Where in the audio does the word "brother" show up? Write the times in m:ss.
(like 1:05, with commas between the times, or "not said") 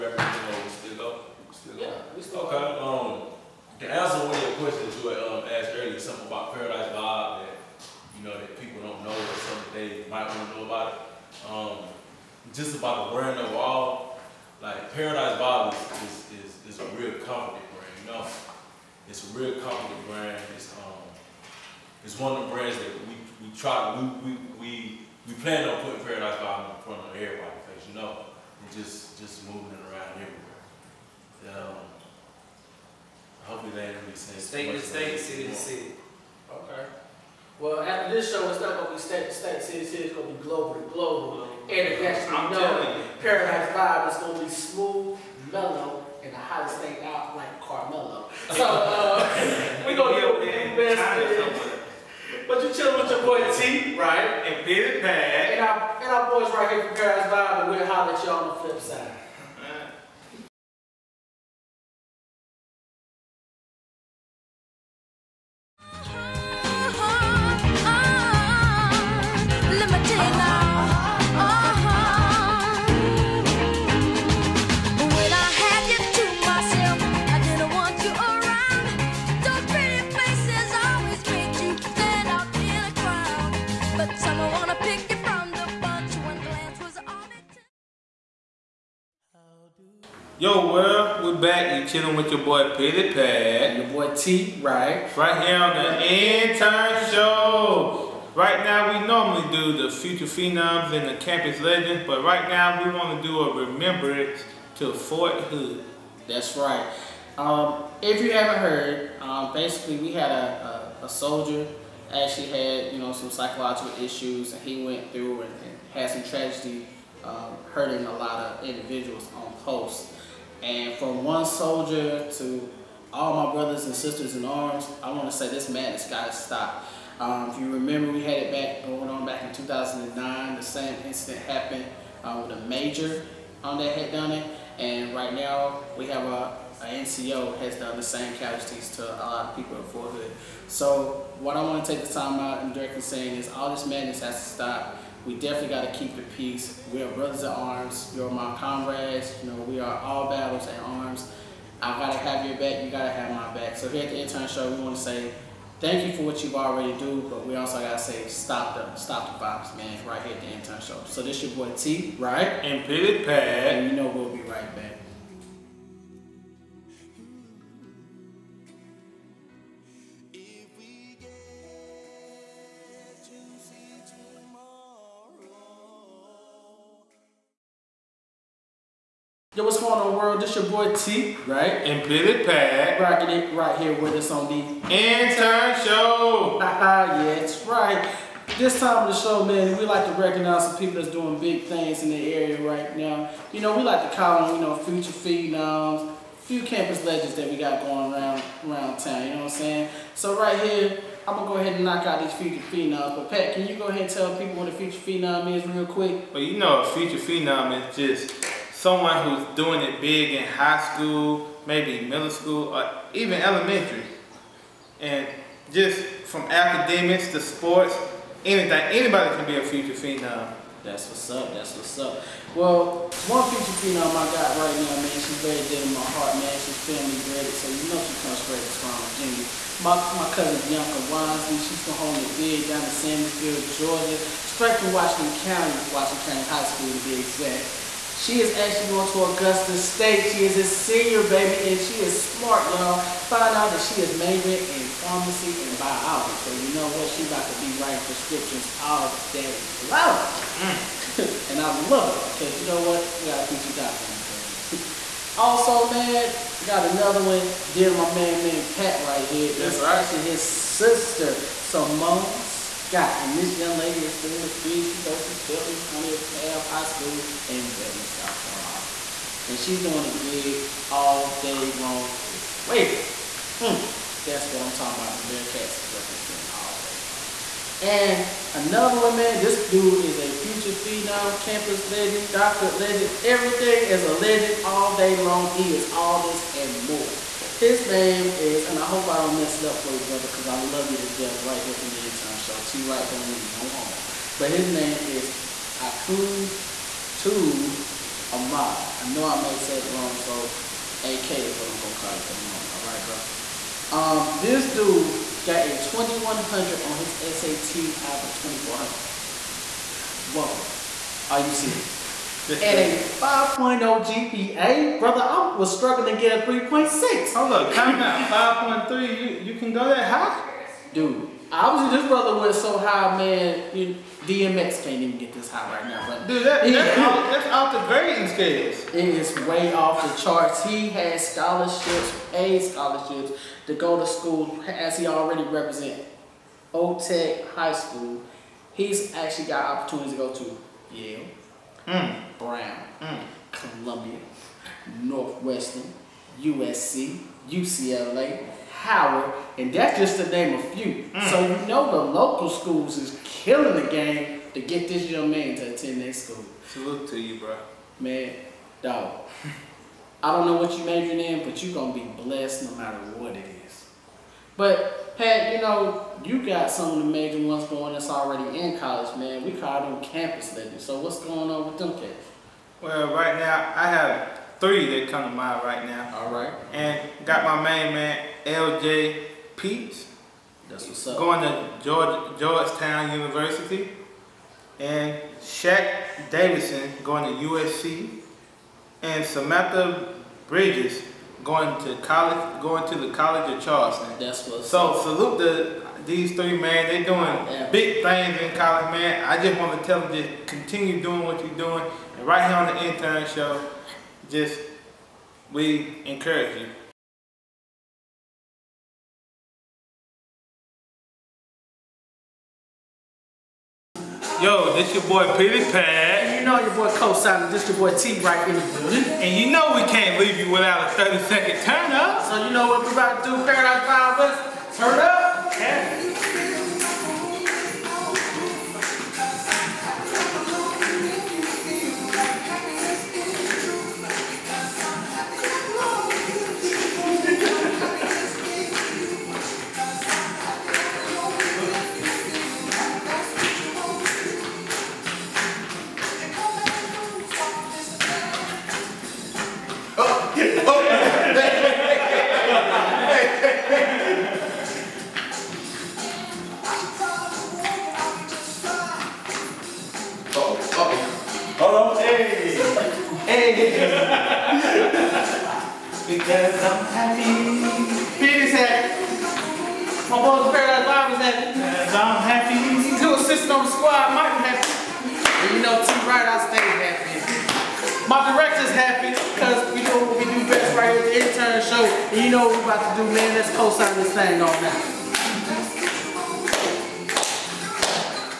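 2:03, 2:27, 4:49, 5:03, 5:14, 5:22.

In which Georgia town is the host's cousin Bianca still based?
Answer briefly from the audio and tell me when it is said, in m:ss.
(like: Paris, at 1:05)
Sandersville, at 3:52.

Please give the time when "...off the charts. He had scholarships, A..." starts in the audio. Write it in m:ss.
5:29.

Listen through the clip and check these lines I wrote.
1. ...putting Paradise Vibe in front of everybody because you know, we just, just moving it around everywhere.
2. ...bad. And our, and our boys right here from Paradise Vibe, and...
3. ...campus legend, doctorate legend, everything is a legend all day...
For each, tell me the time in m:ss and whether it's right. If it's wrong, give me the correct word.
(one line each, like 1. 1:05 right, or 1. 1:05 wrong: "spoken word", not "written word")
1. 0:25 right
2. 0:55 right
3. 4:41 right.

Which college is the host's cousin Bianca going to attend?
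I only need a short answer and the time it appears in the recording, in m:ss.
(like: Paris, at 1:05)
Augusta State, at 3:59.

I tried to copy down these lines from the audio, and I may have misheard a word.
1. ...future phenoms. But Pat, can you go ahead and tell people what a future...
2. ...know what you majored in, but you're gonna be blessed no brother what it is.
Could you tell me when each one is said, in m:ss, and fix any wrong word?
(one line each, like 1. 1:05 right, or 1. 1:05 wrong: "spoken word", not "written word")
1. 3:22 right
2. 6:00 wrong: "matter", not "brother".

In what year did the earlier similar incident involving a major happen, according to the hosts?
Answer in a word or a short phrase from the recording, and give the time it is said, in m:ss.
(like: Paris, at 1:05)
2009, at 2:09.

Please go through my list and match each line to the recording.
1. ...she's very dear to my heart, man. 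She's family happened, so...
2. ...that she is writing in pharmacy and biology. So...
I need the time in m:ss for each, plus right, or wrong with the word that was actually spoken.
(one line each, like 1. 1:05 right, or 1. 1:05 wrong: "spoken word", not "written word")
1. 3:45 wrong: "braided", not "happened"
2. 4:03 wrong: "majoring", not "writing".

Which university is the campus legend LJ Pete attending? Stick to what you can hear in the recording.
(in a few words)
Georgetown University.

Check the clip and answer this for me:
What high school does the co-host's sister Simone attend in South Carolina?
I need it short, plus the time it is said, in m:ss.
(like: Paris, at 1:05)
Belton Honea Path High School, at 4:25.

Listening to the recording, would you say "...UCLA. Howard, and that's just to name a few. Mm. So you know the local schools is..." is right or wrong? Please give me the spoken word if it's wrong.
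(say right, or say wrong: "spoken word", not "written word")
right.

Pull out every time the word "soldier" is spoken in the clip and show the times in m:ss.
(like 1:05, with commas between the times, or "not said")
1:51, 2:01.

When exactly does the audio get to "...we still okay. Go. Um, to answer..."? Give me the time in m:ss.
0:02.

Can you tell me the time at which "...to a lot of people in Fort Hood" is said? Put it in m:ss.
2:18.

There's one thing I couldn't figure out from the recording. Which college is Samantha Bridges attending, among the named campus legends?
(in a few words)
College of Charleston.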